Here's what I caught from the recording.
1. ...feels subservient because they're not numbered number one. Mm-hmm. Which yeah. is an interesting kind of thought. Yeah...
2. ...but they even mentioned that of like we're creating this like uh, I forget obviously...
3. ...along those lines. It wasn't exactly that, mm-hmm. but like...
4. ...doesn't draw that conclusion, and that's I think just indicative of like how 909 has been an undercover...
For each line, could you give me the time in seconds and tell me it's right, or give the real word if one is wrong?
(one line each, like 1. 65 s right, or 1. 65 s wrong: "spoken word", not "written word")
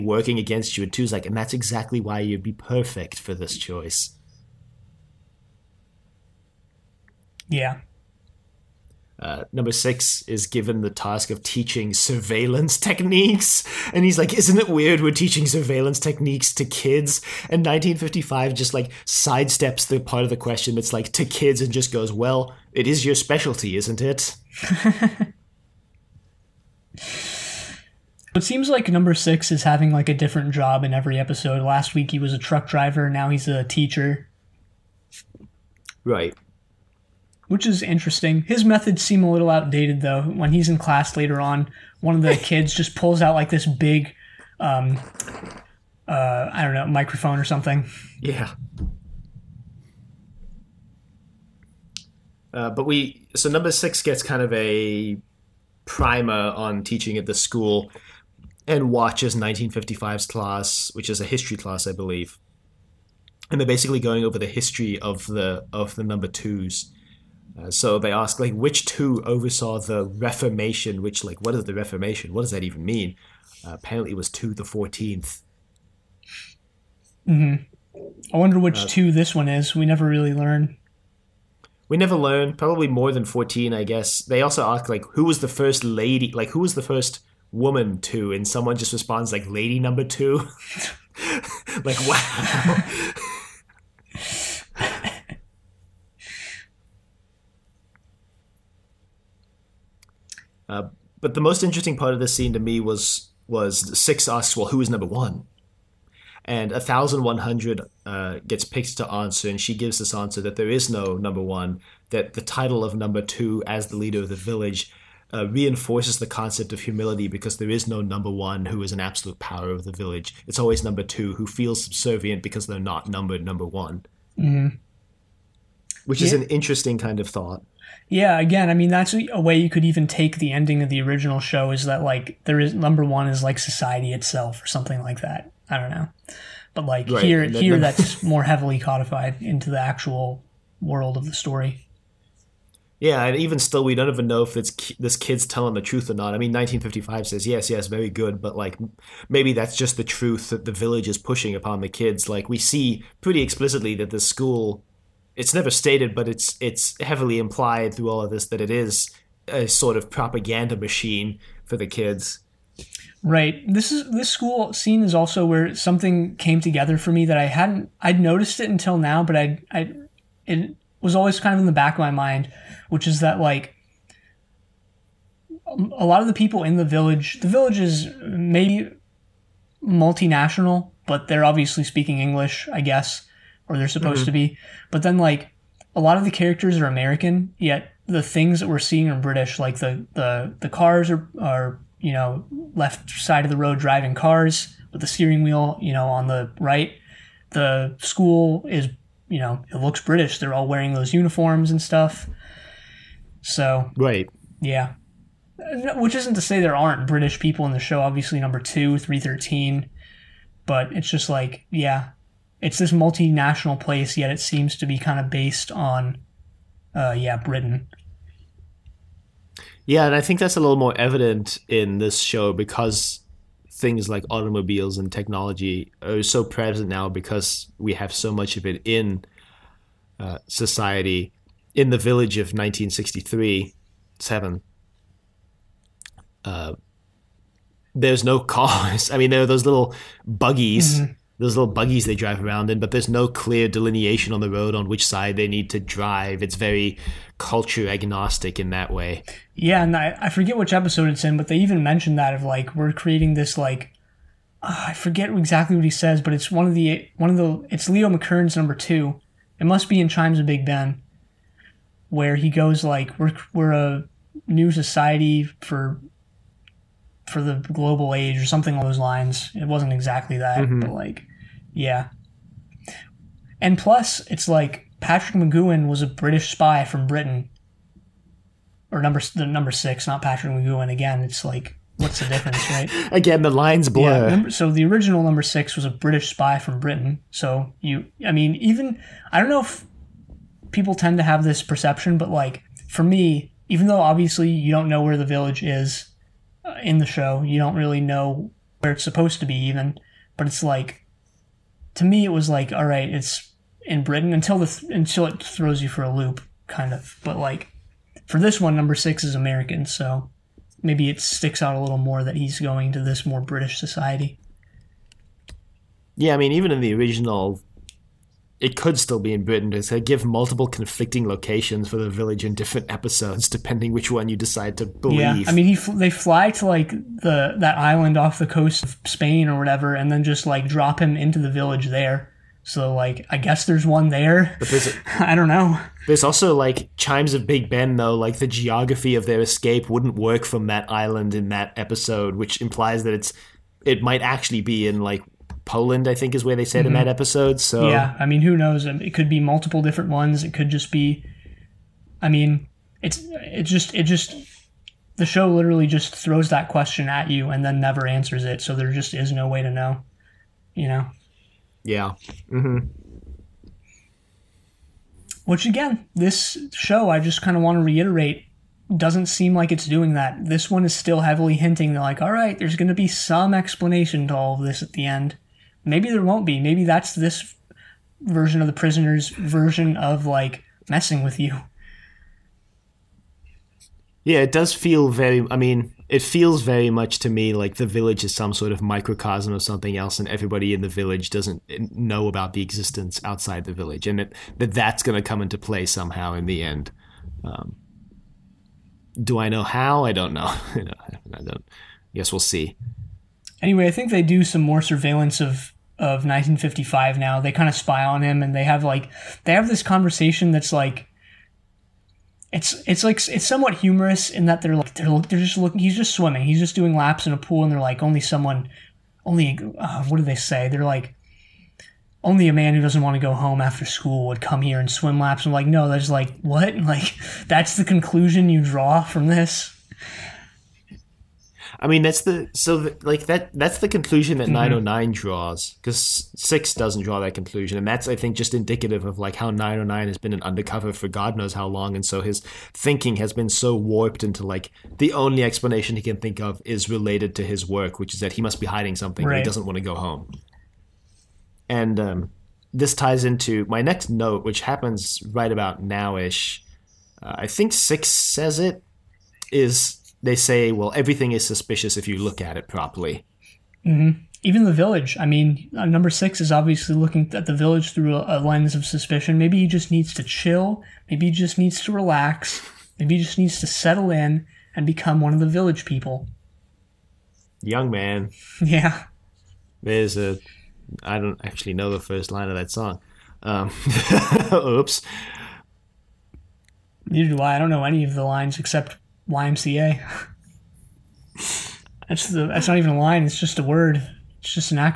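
1. 121 s right
2. 251 s wrong: "exactly", not "obviously"
3. 268 s right
4. 436 s right.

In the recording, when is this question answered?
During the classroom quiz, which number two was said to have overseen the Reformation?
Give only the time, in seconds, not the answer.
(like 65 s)
74 s.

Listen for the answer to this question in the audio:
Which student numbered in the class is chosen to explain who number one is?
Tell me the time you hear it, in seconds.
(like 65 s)
106 s.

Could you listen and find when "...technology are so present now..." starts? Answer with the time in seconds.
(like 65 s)
225 s.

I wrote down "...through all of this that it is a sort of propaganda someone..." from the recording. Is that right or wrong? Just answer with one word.
wrong.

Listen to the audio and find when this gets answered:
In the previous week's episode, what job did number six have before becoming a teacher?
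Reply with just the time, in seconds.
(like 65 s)
32 s.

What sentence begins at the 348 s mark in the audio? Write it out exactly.
Um, it could be multiple different ones.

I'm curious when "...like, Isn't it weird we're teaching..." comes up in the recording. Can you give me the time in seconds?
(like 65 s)
14 s.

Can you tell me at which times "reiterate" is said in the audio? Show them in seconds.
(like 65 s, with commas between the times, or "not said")
367 s.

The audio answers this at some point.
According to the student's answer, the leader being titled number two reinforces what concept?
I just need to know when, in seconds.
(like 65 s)
116 s.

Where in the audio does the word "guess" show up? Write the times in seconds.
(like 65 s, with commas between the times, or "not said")
83 s, 182 s, 333 s, 402 s.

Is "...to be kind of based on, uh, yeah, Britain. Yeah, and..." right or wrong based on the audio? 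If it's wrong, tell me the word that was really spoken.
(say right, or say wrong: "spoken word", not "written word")
right.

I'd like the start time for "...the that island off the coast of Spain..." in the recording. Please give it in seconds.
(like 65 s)
326 s.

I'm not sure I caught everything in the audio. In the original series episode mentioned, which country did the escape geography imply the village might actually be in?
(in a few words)
Poland.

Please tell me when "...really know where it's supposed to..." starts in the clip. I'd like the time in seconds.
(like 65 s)
297 s.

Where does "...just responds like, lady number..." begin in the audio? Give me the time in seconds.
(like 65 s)
88 s.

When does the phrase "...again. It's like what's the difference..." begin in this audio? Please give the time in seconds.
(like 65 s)
280 s.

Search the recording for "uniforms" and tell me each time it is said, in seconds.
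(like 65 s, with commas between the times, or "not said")
201 s.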